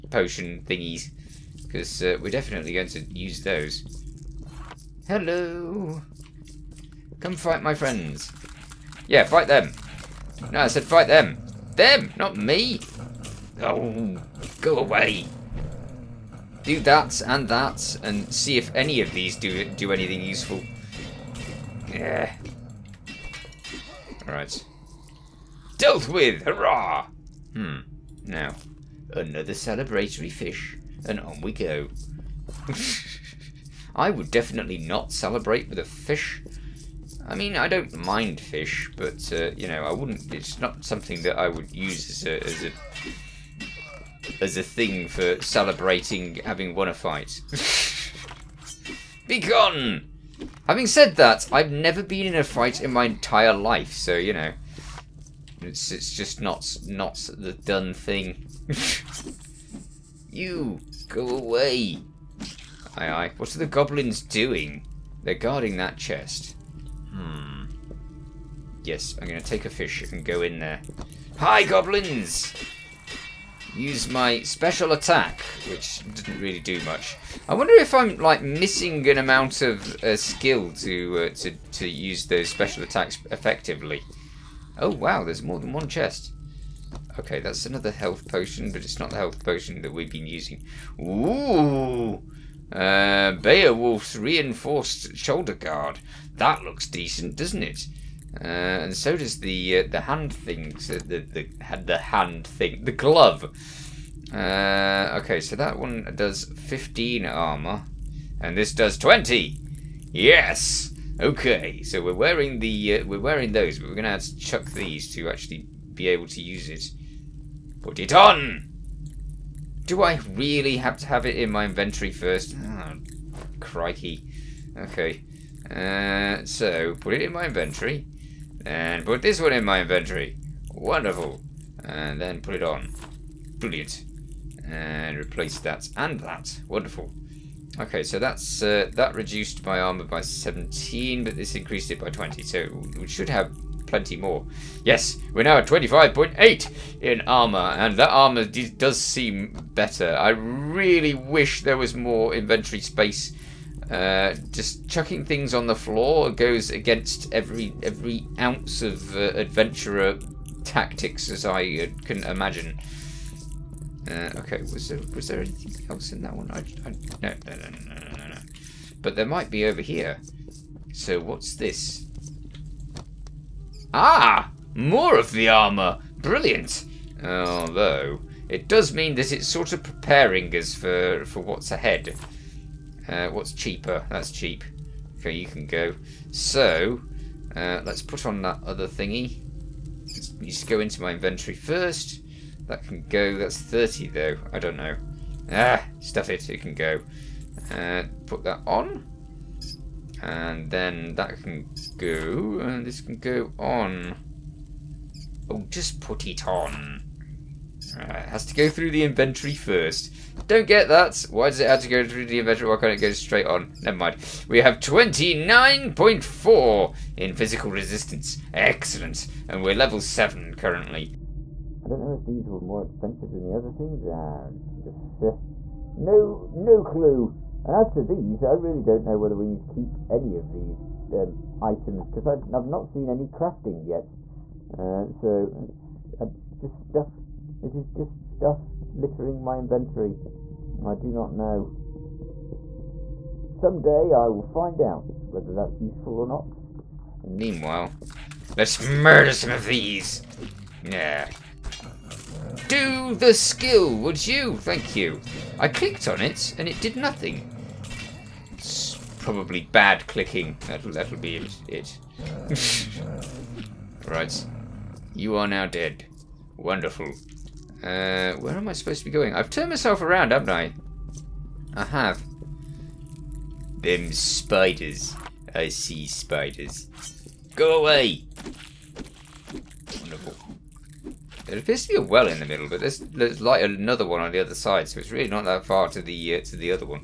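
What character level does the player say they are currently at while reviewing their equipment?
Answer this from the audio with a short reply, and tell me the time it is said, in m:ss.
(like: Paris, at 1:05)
7, at 3:39.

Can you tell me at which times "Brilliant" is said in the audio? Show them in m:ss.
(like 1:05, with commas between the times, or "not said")
2:13, 2:56.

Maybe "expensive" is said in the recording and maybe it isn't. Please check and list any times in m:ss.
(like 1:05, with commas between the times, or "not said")
3:42.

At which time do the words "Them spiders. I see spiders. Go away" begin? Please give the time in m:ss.
4:33.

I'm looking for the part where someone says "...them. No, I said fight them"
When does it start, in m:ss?
0:09.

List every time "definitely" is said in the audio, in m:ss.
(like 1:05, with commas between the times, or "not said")
0:02, 0:34.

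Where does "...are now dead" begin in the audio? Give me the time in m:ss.
4:25.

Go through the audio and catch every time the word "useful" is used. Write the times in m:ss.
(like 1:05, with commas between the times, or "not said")
0:20, 4:05.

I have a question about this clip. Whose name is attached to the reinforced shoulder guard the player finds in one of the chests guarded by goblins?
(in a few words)
Beowulf.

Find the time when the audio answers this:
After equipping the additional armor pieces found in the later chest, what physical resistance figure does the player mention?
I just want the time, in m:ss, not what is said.
3:34.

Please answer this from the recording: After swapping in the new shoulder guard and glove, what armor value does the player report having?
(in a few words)
25.8.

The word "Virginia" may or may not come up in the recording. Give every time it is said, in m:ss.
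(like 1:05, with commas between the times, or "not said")
not said.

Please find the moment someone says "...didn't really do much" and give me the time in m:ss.
1:16.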